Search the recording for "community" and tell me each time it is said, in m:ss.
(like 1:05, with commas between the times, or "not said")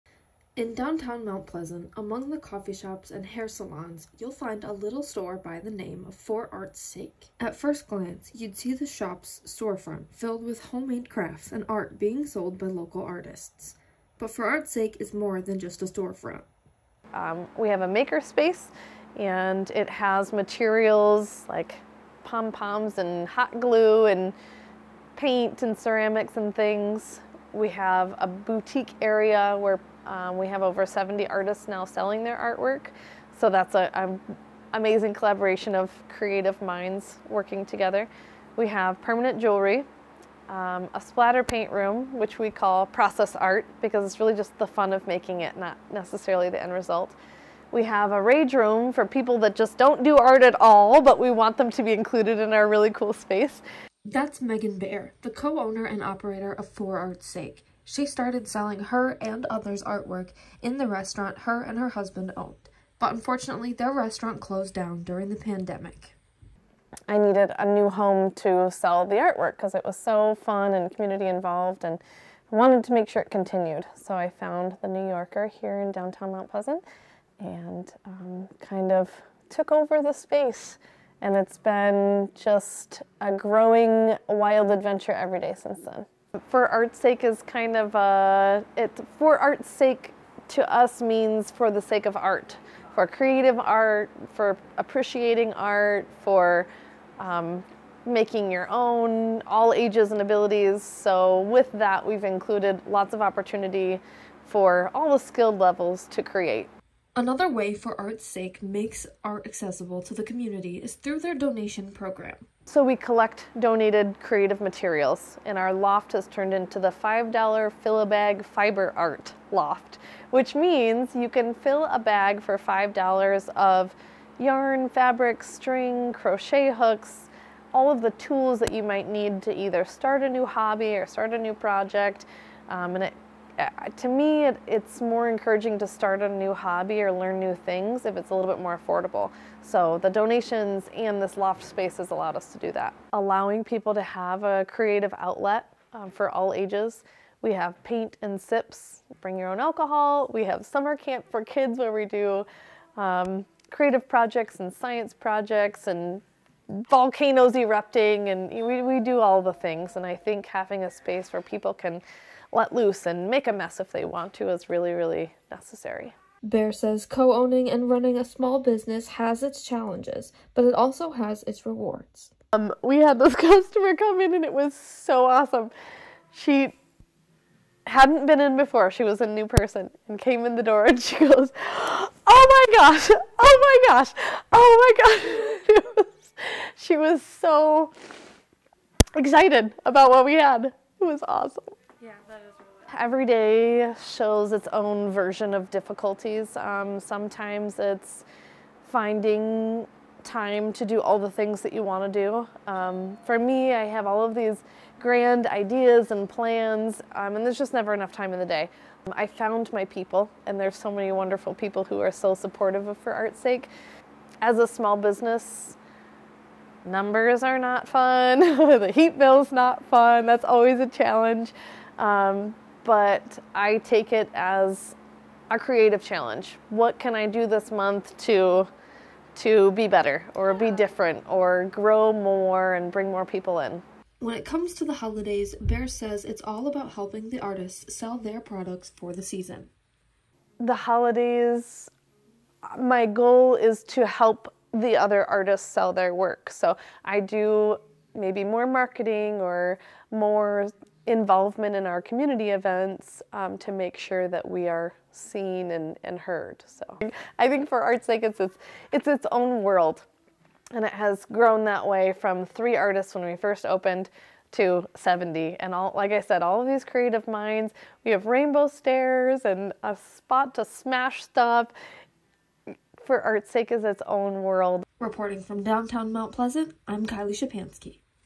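1:10, 1:50, 4:12.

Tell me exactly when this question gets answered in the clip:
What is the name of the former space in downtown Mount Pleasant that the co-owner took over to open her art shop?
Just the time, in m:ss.
1:14.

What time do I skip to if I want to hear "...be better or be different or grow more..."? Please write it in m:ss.
3:49.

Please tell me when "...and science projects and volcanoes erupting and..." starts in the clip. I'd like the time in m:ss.
2:34.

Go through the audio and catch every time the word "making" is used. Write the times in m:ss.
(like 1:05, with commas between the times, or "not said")
0:45, 1:38.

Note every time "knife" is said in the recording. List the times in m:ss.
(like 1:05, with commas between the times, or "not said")
not said.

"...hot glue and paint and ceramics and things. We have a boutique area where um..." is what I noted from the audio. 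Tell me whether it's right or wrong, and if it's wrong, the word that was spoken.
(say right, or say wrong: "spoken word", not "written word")
right.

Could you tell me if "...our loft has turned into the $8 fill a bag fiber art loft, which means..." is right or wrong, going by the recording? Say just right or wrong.
wrong.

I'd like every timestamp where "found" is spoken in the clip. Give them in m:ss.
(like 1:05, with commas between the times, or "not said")
1:14, 3:29.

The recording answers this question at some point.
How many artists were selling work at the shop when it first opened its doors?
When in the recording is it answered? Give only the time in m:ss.
4:22.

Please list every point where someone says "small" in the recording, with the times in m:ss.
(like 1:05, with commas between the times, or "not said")
2:48, 3:34.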